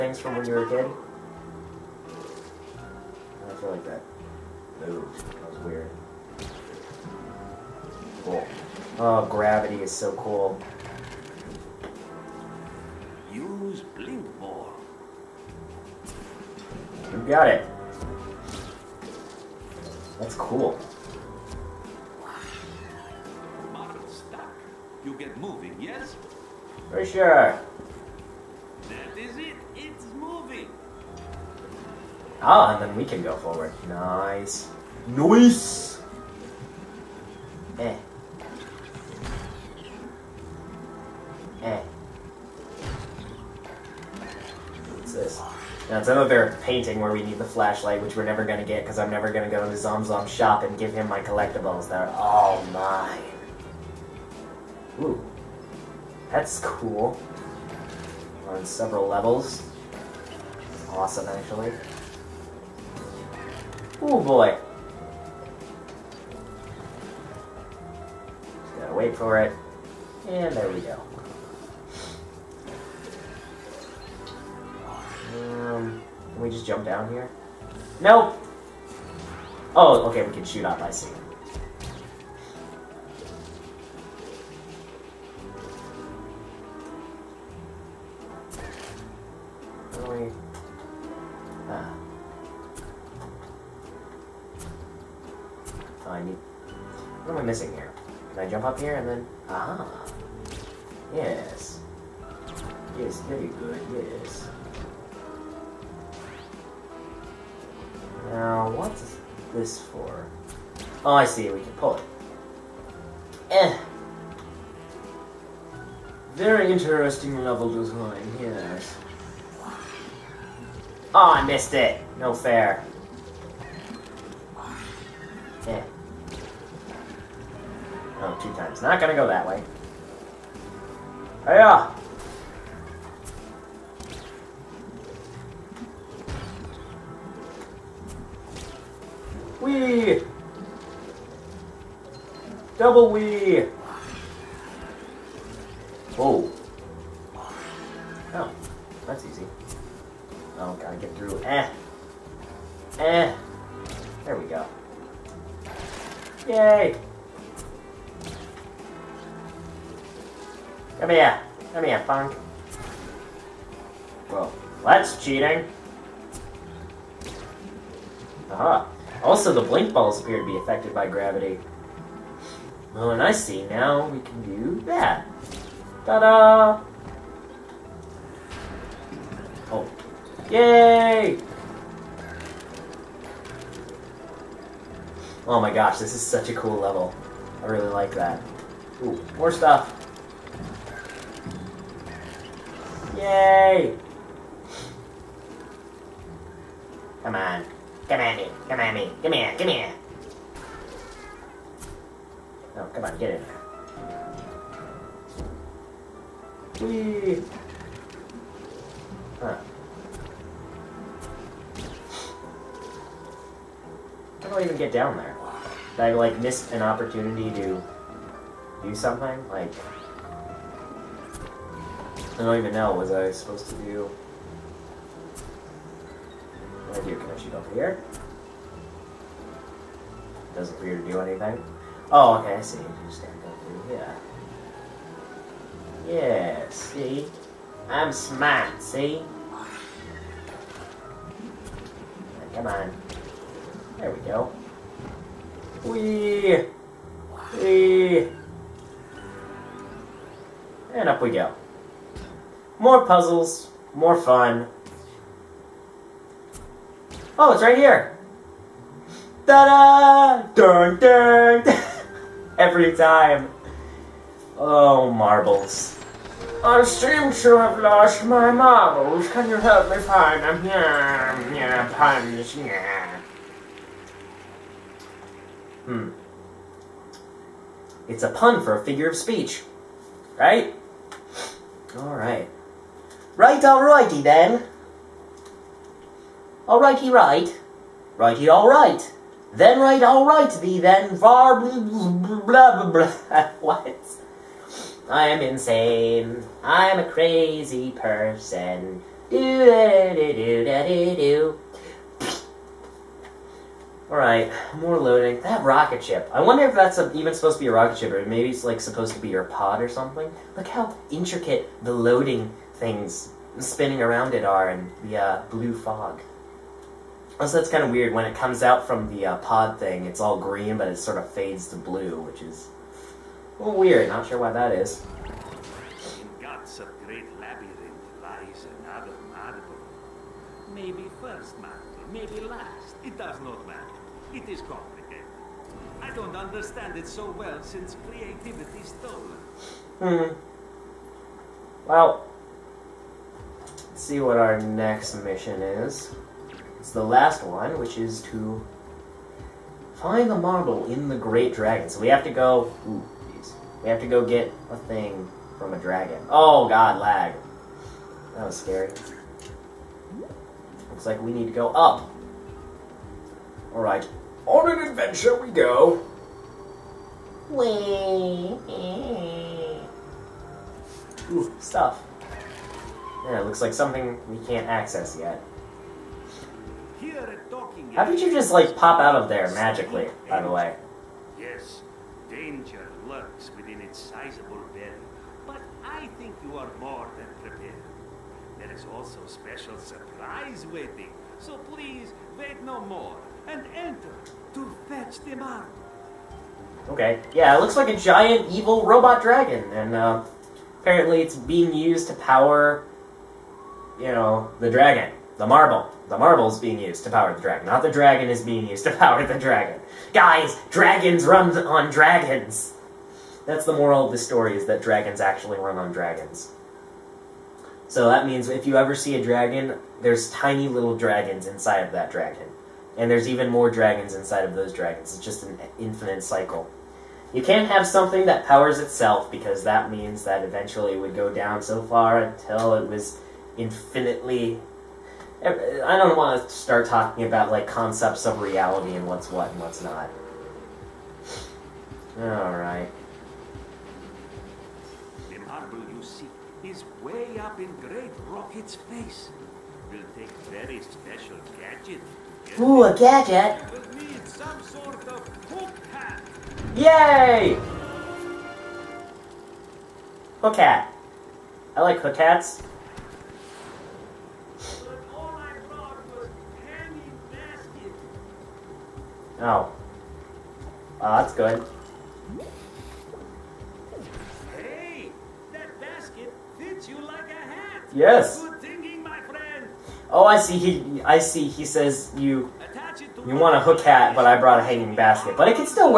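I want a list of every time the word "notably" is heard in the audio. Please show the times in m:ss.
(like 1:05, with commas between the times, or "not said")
not said.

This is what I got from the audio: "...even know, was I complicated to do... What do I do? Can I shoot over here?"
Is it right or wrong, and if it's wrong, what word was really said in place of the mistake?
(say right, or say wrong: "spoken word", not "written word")
wrong: "supposed", not "complicated".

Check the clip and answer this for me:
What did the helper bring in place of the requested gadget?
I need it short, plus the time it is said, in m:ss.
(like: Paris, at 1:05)
a hanging basket, at 8:04.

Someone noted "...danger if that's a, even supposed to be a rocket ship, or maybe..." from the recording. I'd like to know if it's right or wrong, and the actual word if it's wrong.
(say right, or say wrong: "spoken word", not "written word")
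wrong: "wonder", not "danger".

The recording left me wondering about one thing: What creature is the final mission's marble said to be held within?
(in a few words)
the great dragon.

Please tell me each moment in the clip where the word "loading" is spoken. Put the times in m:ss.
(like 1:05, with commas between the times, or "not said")
5:04, 5:11.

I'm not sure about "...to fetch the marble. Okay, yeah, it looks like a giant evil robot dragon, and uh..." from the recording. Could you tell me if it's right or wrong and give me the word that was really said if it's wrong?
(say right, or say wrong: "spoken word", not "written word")
right.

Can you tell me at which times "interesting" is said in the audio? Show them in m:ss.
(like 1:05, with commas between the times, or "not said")
1:56.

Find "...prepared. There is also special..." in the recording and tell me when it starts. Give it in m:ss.
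6:27.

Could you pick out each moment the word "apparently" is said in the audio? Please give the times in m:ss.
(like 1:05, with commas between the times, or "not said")
6:40.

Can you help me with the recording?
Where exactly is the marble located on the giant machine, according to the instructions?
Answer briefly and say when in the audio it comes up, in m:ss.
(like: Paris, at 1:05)
Great Rocket's face, at 7:27.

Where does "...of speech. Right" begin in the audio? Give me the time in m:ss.
4:39.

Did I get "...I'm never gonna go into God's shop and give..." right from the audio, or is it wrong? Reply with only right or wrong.
wrong.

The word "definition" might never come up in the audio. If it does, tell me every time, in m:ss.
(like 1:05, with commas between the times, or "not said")
not said.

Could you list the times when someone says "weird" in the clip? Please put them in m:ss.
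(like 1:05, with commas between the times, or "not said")
5:17, 5:23.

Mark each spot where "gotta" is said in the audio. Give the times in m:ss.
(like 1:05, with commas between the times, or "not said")
1:08, 2:30.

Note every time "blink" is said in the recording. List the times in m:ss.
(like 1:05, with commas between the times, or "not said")
0:13, 2:49.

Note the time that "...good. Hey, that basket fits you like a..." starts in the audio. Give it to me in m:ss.
7:51.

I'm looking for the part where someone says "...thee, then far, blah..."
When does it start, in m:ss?
4:50.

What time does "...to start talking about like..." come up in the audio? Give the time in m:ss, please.
7:16.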